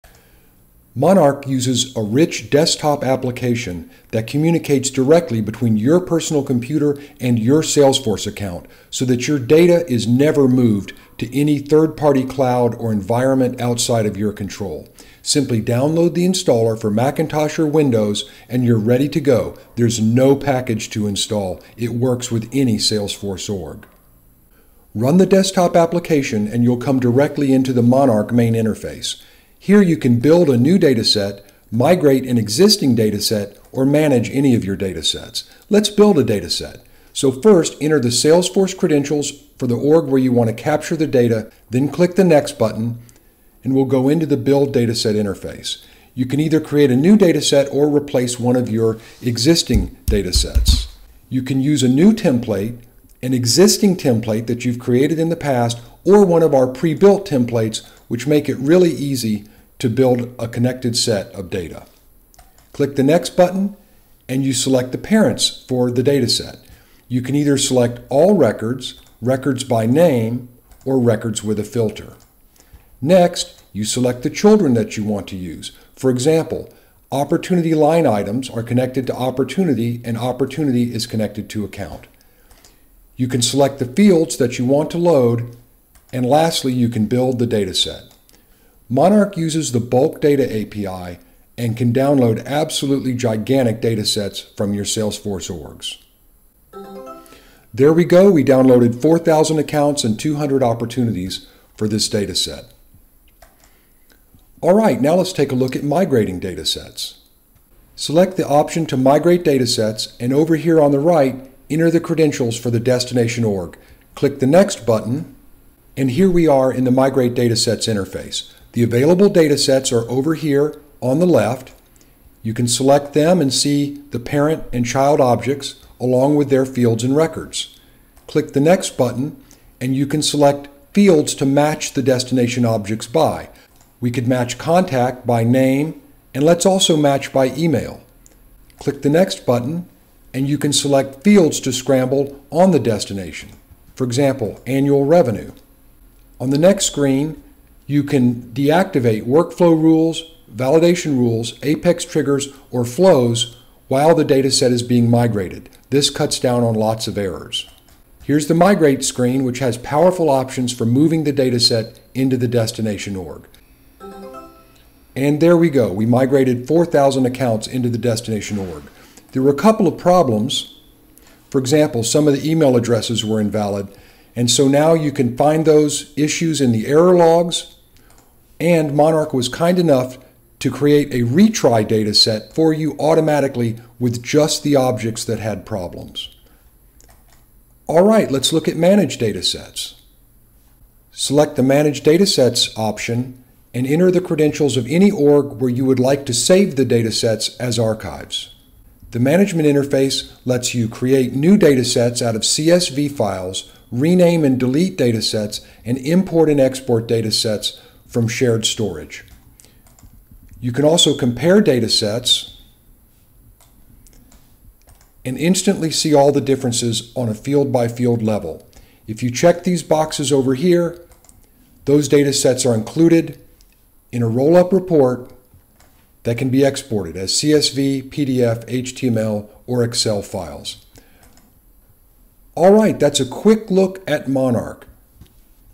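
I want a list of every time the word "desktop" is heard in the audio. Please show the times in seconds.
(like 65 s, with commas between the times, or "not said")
2 s, 25 s.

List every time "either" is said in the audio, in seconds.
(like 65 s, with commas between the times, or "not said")
46 s, 67 s.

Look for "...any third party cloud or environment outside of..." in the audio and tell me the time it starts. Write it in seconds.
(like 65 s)
11 s.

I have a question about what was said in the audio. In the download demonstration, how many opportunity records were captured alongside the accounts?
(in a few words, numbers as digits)
200.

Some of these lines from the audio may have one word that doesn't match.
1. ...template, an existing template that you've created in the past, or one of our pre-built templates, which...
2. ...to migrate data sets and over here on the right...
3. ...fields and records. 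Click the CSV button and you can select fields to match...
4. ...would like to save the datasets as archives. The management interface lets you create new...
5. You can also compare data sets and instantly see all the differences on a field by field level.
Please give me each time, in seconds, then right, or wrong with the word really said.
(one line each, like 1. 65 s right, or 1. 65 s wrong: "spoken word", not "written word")
1. 52 s right
2. 108 s right
3. 126 s wrong: "Next", not "CSV"
4. 195 s right
5. 210 s right.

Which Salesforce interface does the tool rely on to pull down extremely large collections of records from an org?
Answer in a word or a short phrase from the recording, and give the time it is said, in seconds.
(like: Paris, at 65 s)
Bulk data API, at 89 s.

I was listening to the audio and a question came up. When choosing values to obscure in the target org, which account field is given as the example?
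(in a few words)
Annual revenue.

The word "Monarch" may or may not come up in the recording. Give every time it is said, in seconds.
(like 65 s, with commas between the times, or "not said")
0 s, 27 s, 88 s, 178 s, 234 s.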